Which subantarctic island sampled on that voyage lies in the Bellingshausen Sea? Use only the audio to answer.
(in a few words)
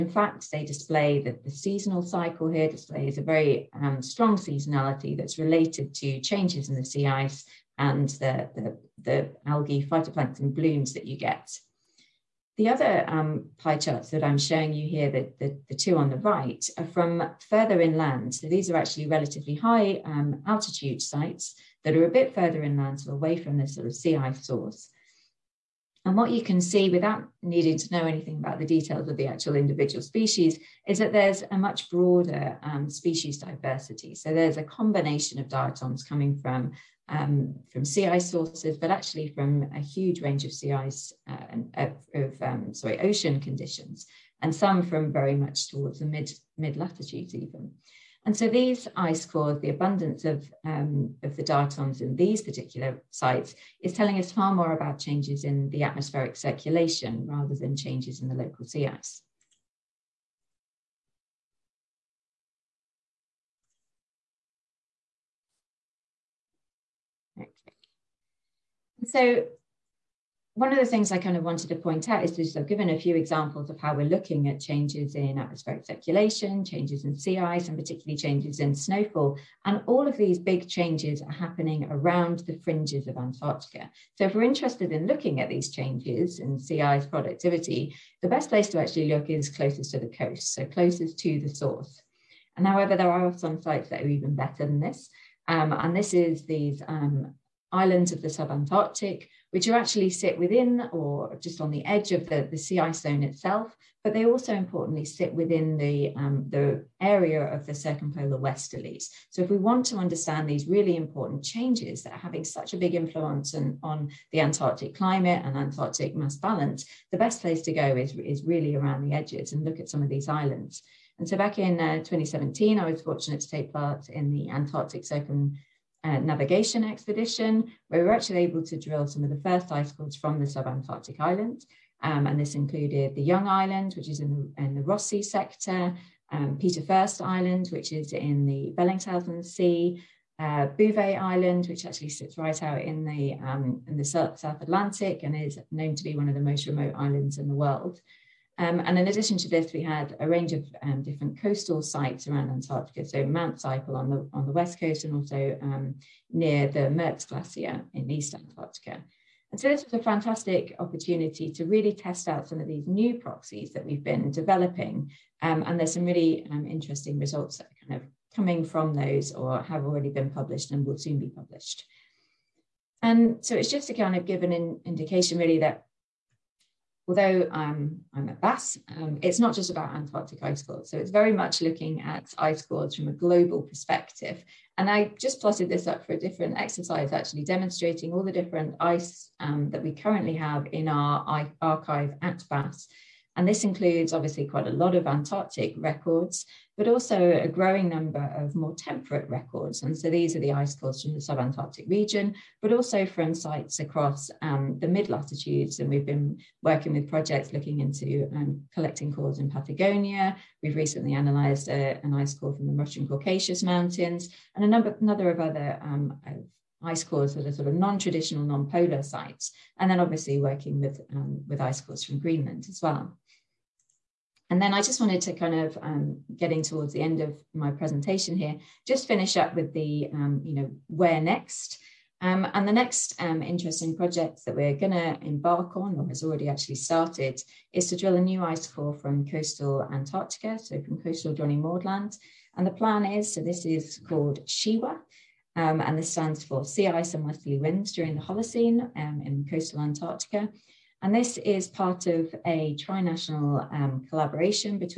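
Peter First Island.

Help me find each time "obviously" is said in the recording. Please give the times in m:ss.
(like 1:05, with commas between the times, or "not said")
3:14, 3:39.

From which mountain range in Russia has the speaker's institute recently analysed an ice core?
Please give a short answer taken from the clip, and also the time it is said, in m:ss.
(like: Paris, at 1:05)
Caucasus Mountains, at 3:33.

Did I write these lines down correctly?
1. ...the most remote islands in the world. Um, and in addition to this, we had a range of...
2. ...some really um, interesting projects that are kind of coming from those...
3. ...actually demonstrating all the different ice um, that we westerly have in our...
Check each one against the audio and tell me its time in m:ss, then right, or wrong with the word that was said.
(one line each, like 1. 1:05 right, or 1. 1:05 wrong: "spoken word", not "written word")
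1. 2:26 right
2. 2:45 wrong: "results", not "projects"
3. 3:07 wrong: "currently", not "westerly".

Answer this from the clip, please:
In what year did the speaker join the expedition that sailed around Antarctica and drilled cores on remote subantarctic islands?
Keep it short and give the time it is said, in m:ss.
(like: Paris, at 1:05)
2017, at 2:01.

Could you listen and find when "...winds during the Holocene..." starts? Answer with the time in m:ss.
4:07.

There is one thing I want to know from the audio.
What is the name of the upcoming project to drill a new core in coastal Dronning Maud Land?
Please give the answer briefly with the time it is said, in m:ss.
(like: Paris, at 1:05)
Shiwa, at 4:04.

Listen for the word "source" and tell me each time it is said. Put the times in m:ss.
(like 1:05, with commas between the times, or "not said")
0:24, 0:38, 1:31.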